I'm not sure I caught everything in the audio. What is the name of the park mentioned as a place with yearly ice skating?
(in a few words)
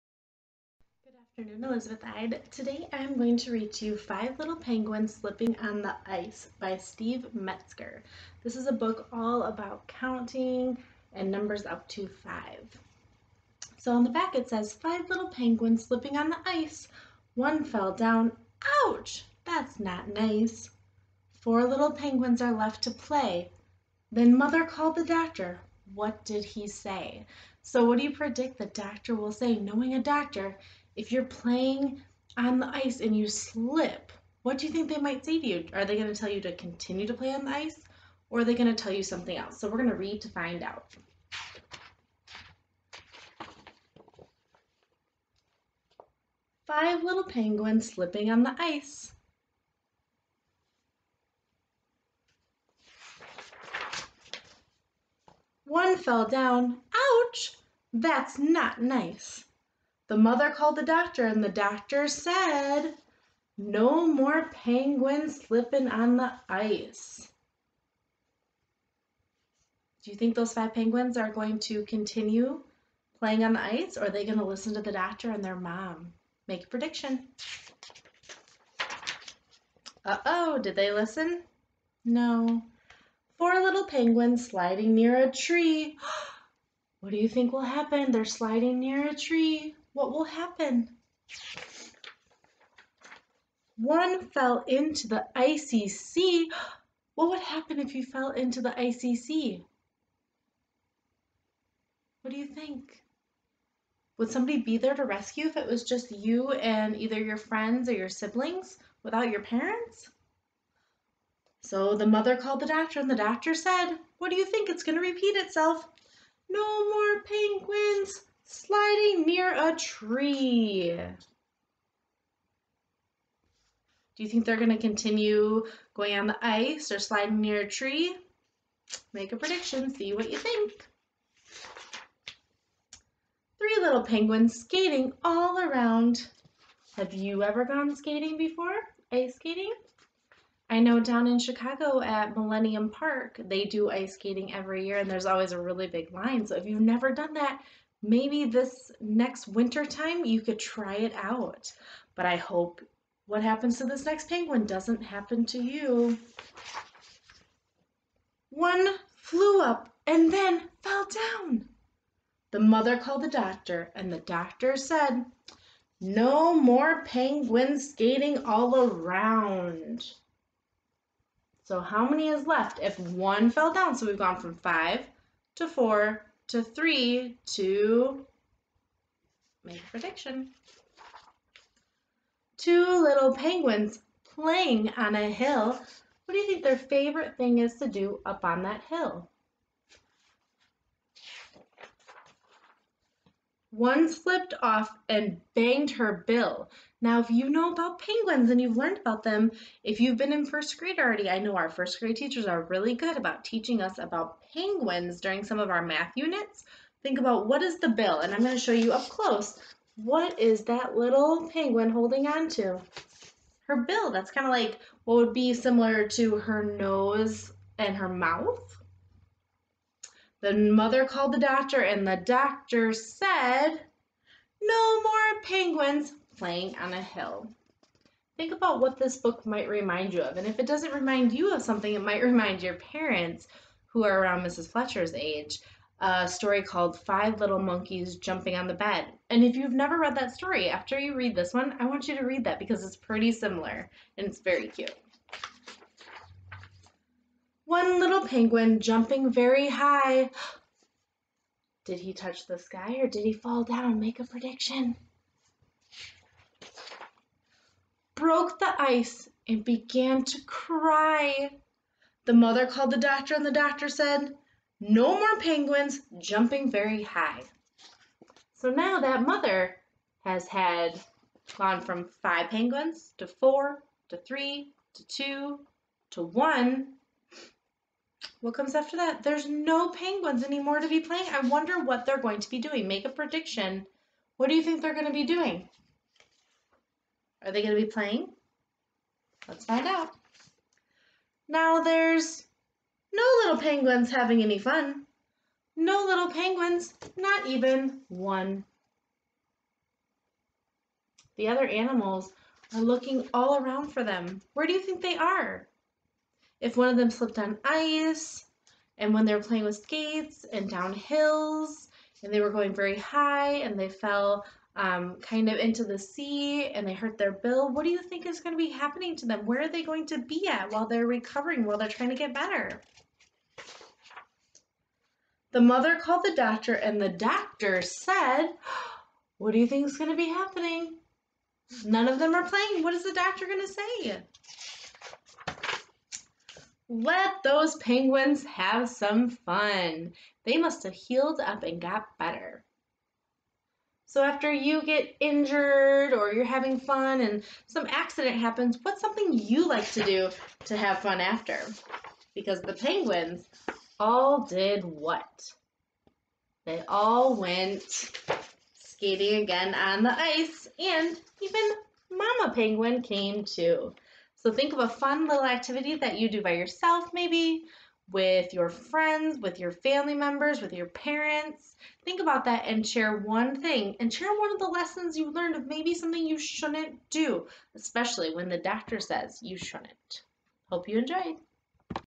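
Millennium Park.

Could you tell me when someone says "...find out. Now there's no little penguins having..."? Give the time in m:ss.
4:49.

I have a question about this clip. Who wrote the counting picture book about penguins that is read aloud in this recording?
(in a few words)
Steve Metzger.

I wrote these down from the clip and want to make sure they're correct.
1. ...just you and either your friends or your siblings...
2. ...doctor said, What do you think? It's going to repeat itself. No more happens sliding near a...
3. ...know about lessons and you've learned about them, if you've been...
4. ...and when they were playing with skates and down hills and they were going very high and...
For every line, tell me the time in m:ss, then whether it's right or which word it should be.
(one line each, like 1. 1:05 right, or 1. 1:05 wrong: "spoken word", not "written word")
1. 1:45 right
2. 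1:53 wrong: "penguins", not "happens"
3. 3:17 wrong: "penguins", not "lessons"
4. 5:08 right.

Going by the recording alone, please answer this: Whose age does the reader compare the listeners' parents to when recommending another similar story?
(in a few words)
Mrs. Fletcher.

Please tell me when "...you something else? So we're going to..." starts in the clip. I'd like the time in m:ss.
0:38.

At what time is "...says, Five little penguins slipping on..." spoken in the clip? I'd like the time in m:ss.
0:14.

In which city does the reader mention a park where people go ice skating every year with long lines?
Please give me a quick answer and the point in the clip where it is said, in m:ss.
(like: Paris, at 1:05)
Chicago, at 2:21.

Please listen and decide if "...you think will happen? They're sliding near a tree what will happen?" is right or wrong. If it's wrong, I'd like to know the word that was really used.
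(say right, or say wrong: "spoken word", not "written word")
right.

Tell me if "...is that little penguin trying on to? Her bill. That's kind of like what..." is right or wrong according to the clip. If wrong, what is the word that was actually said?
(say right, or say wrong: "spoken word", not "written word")
wrong: "holding", not "trying".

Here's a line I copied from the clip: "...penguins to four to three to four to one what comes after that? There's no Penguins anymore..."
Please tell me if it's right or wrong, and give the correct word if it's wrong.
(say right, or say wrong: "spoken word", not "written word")
wrong: "two", not "four".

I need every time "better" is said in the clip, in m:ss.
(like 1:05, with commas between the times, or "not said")
5:22, 5:42.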